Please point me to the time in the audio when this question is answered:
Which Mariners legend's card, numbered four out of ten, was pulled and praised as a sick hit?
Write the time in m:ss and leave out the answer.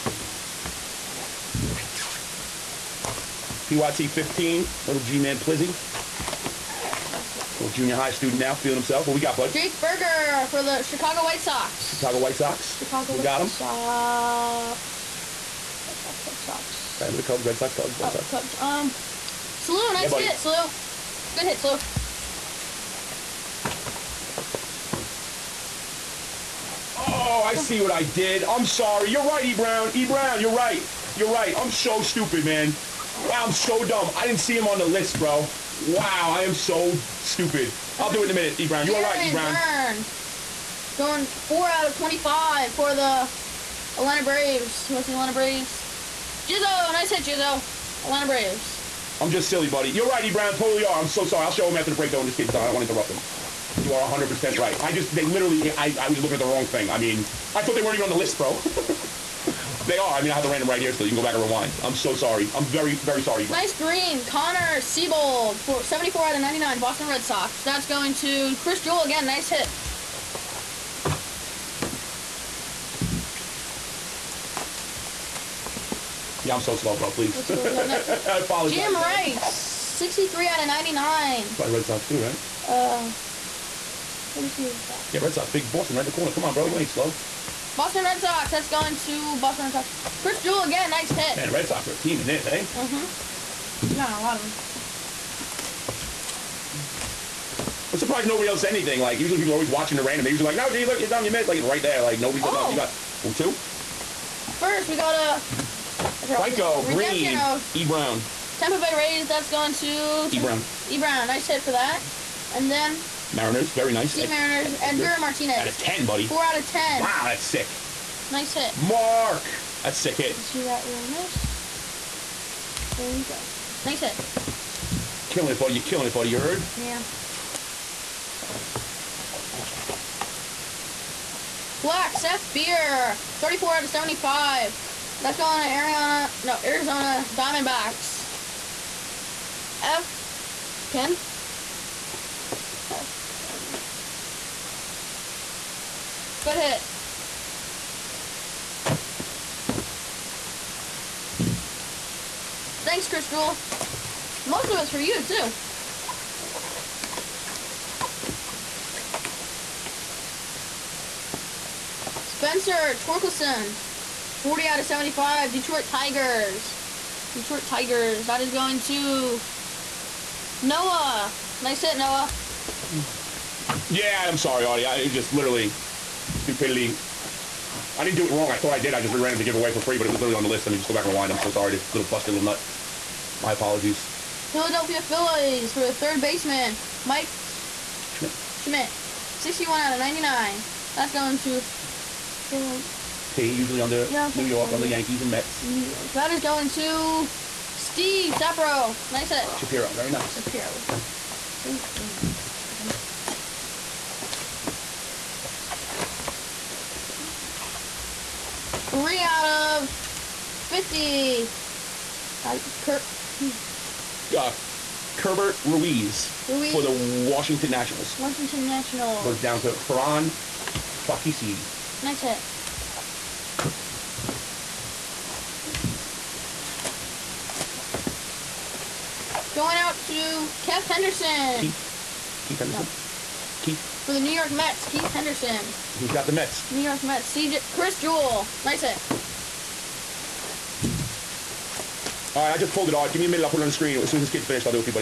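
1:55.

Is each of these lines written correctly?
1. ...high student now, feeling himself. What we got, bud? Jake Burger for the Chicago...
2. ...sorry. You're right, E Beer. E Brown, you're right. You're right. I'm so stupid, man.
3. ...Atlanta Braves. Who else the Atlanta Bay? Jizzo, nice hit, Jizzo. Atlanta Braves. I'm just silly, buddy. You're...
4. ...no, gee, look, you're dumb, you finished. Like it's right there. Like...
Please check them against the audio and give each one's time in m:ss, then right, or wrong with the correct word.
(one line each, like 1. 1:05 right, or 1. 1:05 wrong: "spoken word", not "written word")
1. 0:07 right
2. 0:28 wrong: "Brown", not "Beer"
3. 0:43 wrong: "Braves", not "Bay"
4. 1:40 wrong: "missed", not "finished".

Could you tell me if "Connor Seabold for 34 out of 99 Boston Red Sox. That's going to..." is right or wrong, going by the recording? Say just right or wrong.
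wrong.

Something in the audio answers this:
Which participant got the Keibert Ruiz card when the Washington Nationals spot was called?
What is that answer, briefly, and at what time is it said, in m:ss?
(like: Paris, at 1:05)
Ferran Fakisi, at 3:39.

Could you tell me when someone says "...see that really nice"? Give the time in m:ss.
2:00.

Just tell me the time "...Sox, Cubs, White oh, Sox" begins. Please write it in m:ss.
0:17.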